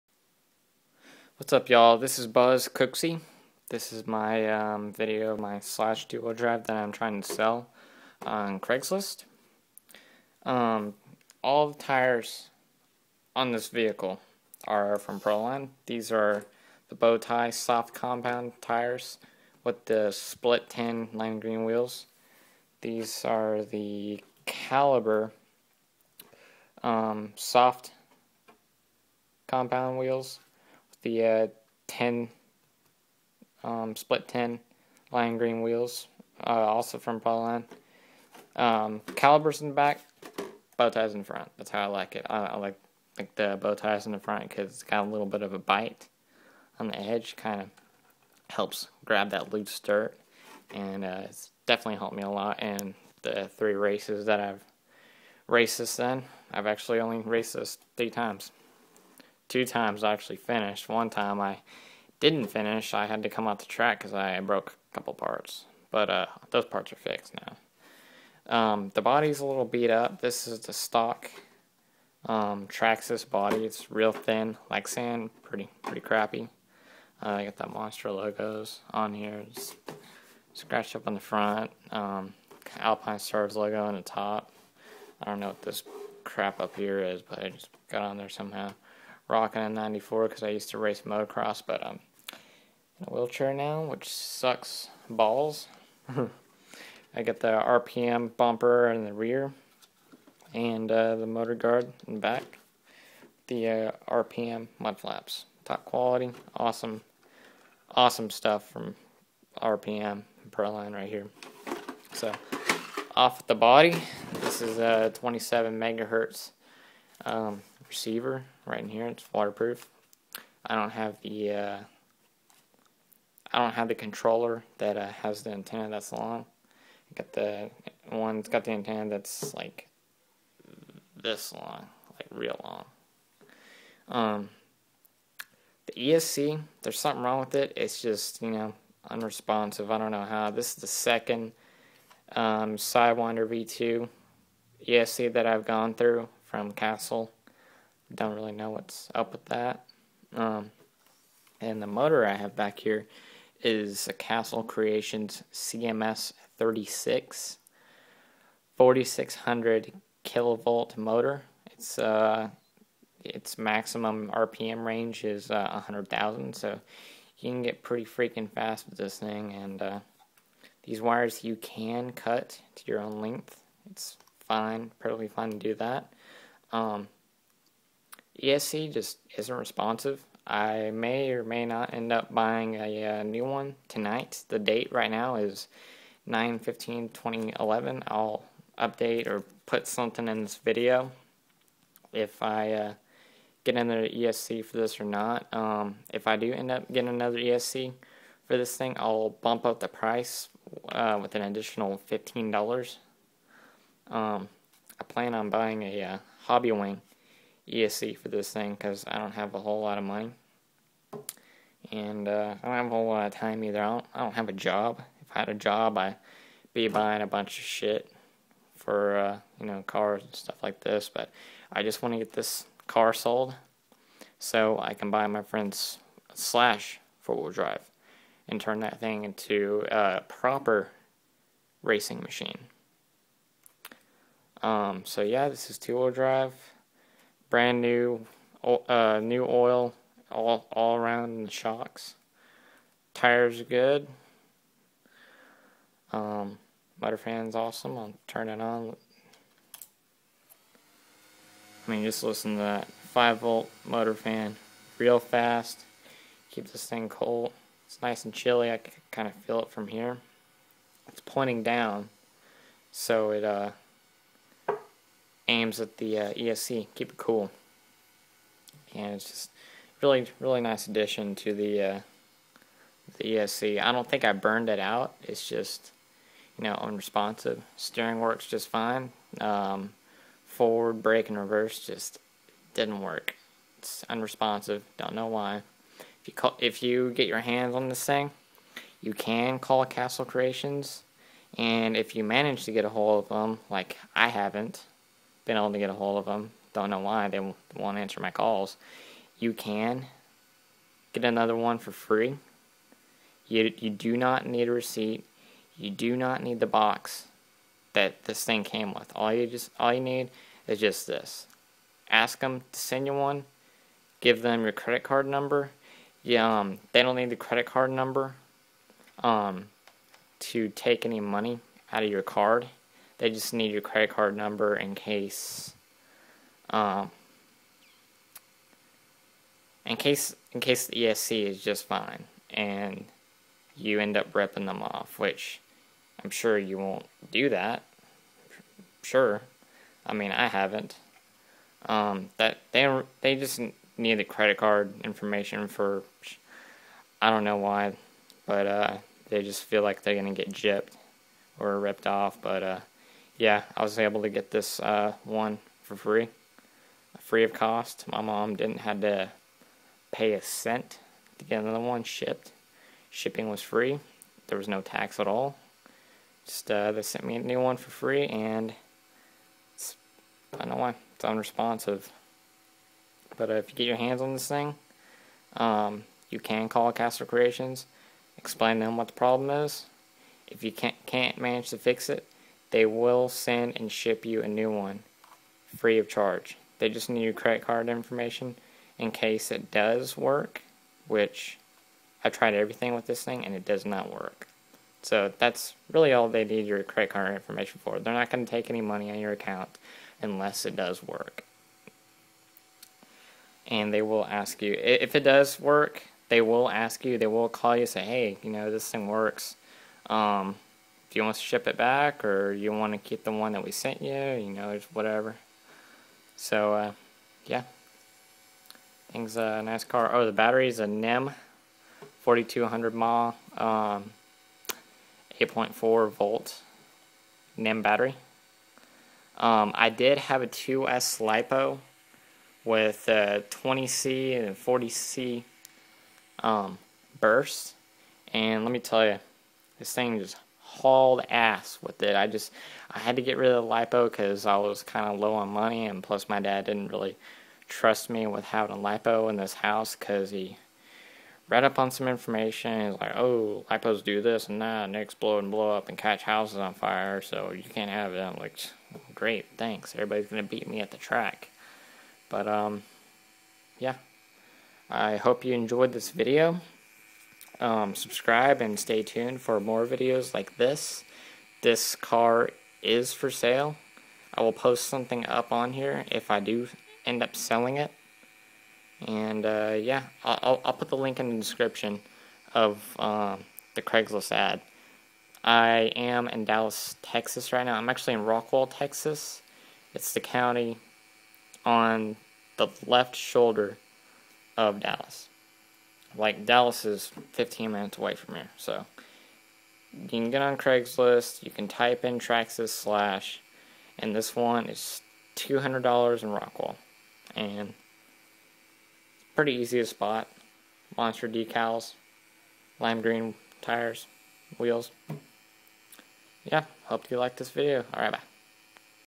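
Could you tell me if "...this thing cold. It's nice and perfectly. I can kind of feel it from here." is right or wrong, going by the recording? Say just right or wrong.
wrong.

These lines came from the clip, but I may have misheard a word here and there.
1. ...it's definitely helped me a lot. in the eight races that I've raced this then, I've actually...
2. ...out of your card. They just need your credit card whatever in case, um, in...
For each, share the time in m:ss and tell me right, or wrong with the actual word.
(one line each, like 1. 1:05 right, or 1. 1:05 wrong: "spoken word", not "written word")
1. 0:51 wrong: "three", not "eight"
2. 5:21 wrong: "number", not "whatever".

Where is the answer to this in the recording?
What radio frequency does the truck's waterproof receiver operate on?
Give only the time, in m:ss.
1:55.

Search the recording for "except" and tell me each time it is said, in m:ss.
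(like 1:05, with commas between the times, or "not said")
not said.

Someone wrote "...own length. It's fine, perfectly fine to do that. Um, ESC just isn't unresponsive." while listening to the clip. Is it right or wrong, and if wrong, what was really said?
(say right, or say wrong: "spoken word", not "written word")
wrong: "responsive", not "unresponsive".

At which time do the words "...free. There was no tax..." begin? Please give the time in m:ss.
6:03.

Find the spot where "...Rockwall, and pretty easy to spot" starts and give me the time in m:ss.
8:26.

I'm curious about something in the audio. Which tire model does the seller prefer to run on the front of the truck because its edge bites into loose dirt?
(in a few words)
Bow tie.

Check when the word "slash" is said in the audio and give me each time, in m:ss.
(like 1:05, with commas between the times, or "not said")
0:05, 3:46, 8:22.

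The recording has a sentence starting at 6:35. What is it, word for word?
So that's really all they need your credit card information for.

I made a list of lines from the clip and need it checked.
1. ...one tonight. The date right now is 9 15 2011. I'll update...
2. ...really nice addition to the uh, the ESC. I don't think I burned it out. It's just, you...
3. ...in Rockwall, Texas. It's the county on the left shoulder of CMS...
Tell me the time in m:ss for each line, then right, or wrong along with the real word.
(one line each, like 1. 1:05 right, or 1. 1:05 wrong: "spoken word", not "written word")
1. 3:03 right
2. 4:30 right
3. 8:08 wrong: "Dallas", not "CMS".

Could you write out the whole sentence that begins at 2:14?
Um, the ESC, there's something wrong with it.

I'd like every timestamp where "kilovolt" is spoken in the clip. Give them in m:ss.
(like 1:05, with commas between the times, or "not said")
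2:40.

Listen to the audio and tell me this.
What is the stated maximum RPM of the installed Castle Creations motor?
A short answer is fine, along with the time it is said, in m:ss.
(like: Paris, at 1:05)
100,000, at 2:45.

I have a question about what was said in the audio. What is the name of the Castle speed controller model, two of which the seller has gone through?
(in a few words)
Sidewinder V2.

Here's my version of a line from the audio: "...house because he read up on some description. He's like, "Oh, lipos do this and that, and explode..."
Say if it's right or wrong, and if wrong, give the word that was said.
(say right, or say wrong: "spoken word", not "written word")
wrong: "information", not "description".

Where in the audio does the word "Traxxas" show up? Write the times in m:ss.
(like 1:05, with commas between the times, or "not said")
1:12, 8:22.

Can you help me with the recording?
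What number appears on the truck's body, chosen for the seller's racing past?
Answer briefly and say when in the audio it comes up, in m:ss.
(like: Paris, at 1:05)
94, at 1:29.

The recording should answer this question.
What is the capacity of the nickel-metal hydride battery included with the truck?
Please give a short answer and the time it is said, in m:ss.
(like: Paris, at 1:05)
4200 mAh, at 7:02.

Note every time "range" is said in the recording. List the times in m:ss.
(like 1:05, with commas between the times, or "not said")
2:44.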